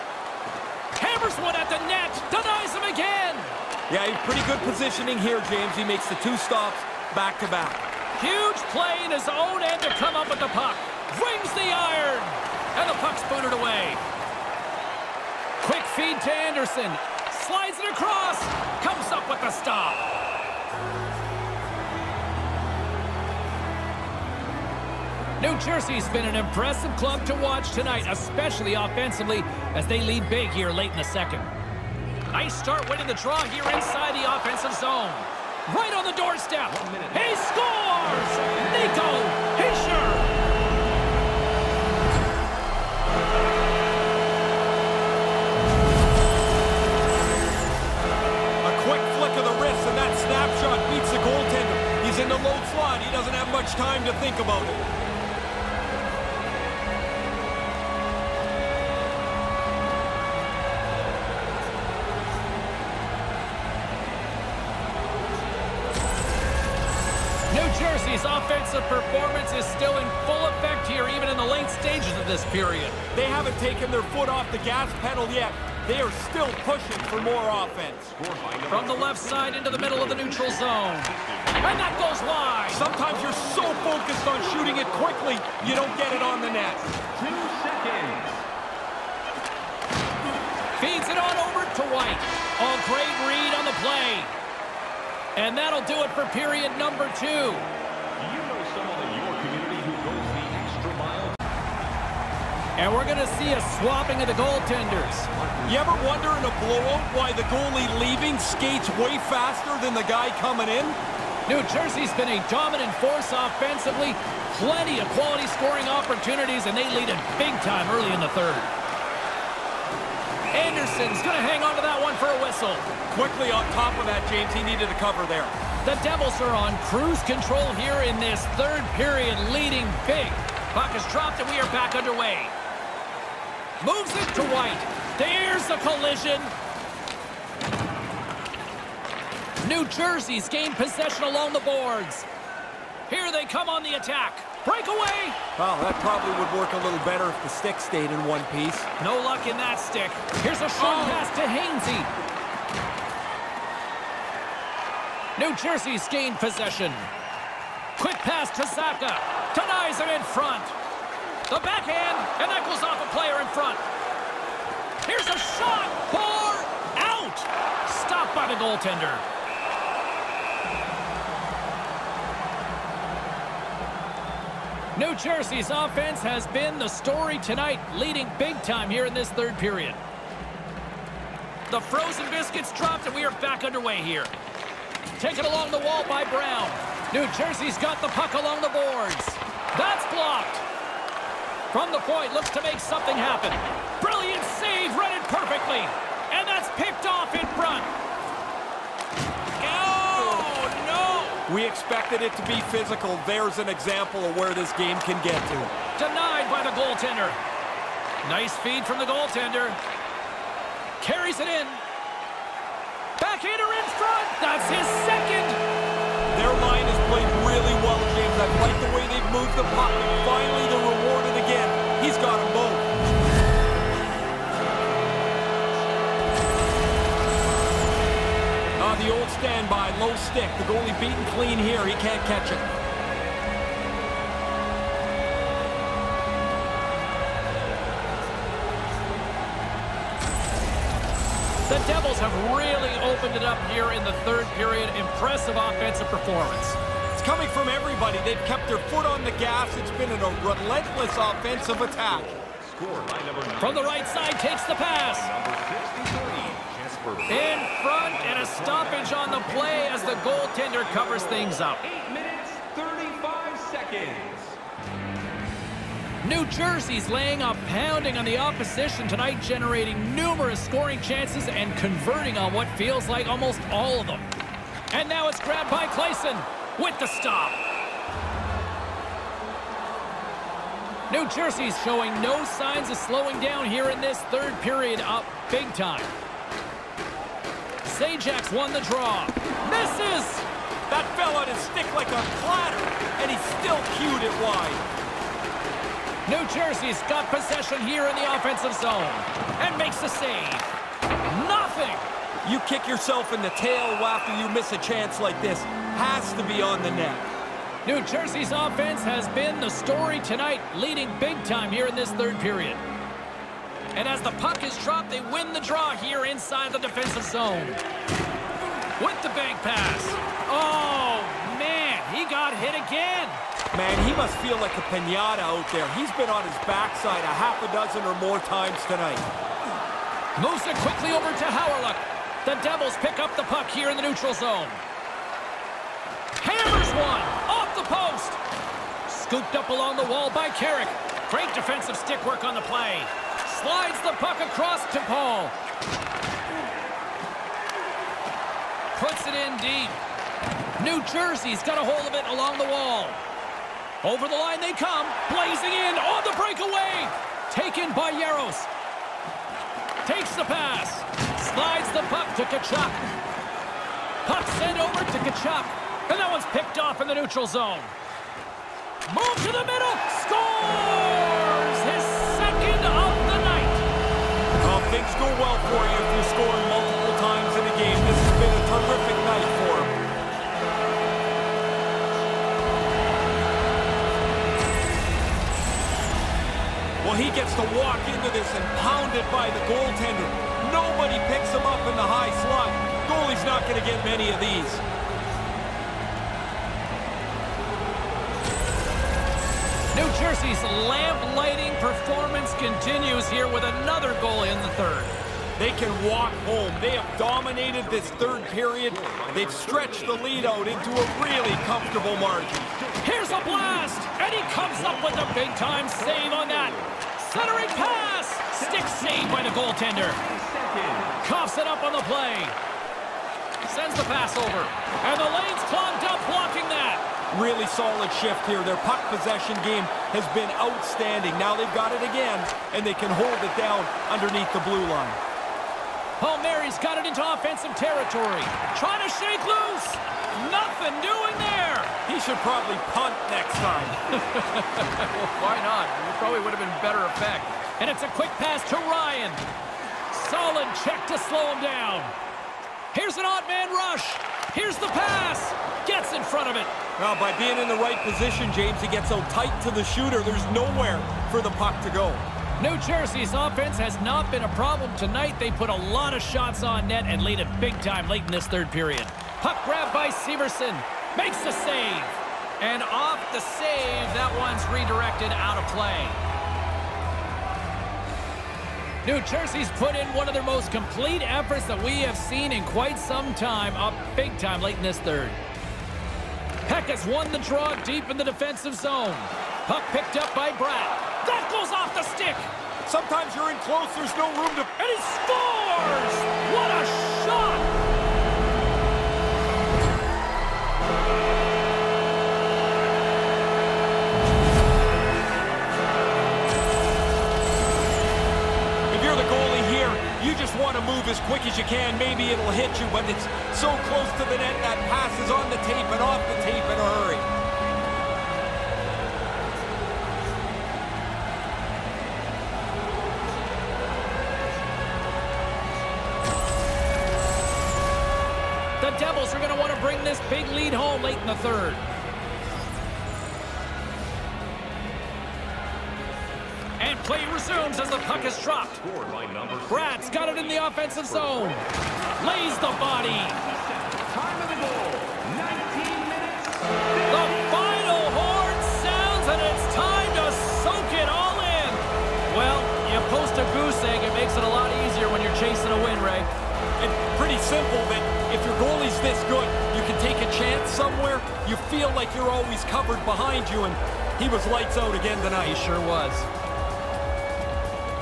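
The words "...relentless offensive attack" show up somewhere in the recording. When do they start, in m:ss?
4:10.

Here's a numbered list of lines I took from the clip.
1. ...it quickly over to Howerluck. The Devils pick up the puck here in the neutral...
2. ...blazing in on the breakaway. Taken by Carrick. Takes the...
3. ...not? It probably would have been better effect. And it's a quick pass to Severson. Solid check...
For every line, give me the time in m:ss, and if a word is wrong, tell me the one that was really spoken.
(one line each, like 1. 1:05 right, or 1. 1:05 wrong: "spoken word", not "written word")
1. 5:30 right
2. 5:55 wrong: "Jaros", not "Carrick"
3. 7:25 wrong: "Ryan", not "Severson".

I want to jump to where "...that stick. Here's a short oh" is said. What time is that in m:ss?
2:29.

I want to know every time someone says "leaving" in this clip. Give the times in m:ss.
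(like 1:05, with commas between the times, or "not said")
1:47.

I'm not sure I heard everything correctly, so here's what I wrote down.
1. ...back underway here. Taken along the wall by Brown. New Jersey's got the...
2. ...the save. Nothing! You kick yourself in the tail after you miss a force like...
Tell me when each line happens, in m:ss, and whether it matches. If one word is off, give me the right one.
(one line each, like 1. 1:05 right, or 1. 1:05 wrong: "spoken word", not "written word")
1. 3:03 right
2. 5:00 wrong: "chance", not "force".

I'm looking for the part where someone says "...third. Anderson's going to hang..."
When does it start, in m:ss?
1:58.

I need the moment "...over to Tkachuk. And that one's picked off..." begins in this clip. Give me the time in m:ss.
6:04.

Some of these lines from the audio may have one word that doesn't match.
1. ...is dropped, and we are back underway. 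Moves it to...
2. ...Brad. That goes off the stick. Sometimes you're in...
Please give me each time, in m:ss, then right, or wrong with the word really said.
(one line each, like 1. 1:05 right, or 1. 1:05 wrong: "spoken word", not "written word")
1. 2:10 right
2. 8:10 right.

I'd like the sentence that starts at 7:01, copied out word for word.
Coughs it up on the play.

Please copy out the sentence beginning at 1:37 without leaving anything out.
You know someone in your community who goes the extra mile?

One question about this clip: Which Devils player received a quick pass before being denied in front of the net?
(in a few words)
Zacha.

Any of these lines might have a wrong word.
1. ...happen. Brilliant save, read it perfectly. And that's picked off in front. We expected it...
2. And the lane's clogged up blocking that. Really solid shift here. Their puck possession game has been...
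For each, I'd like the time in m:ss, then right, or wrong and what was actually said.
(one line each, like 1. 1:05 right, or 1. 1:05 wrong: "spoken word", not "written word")
1. 3:13 right
2. 7:05 right.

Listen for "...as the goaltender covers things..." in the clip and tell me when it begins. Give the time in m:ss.
4:19.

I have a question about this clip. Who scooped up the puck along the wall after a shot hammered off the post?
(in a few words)
Carrick.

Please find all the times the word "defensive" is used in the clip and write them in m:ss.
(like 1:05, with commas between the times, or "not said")
5:16, 5:41, 8:08.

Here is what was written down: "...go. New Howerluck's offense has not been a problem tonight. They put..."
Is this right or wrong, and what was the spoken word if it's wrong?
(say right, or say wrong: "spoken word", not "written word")
wrong: "Jersey", not "Howerluck".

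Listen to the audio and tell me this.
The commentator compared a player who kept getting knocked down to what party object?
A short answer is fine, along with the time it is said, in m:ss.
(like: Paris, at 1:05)
A pinata, at 5:24.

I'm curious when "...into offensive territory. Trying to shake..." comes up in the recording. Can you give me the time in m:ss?
7:17.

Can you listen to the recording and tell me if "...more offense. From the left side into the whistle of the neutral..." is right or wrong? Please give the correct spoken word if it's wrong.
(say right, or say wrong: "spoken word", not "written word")
wrong: "middle", not "whistle".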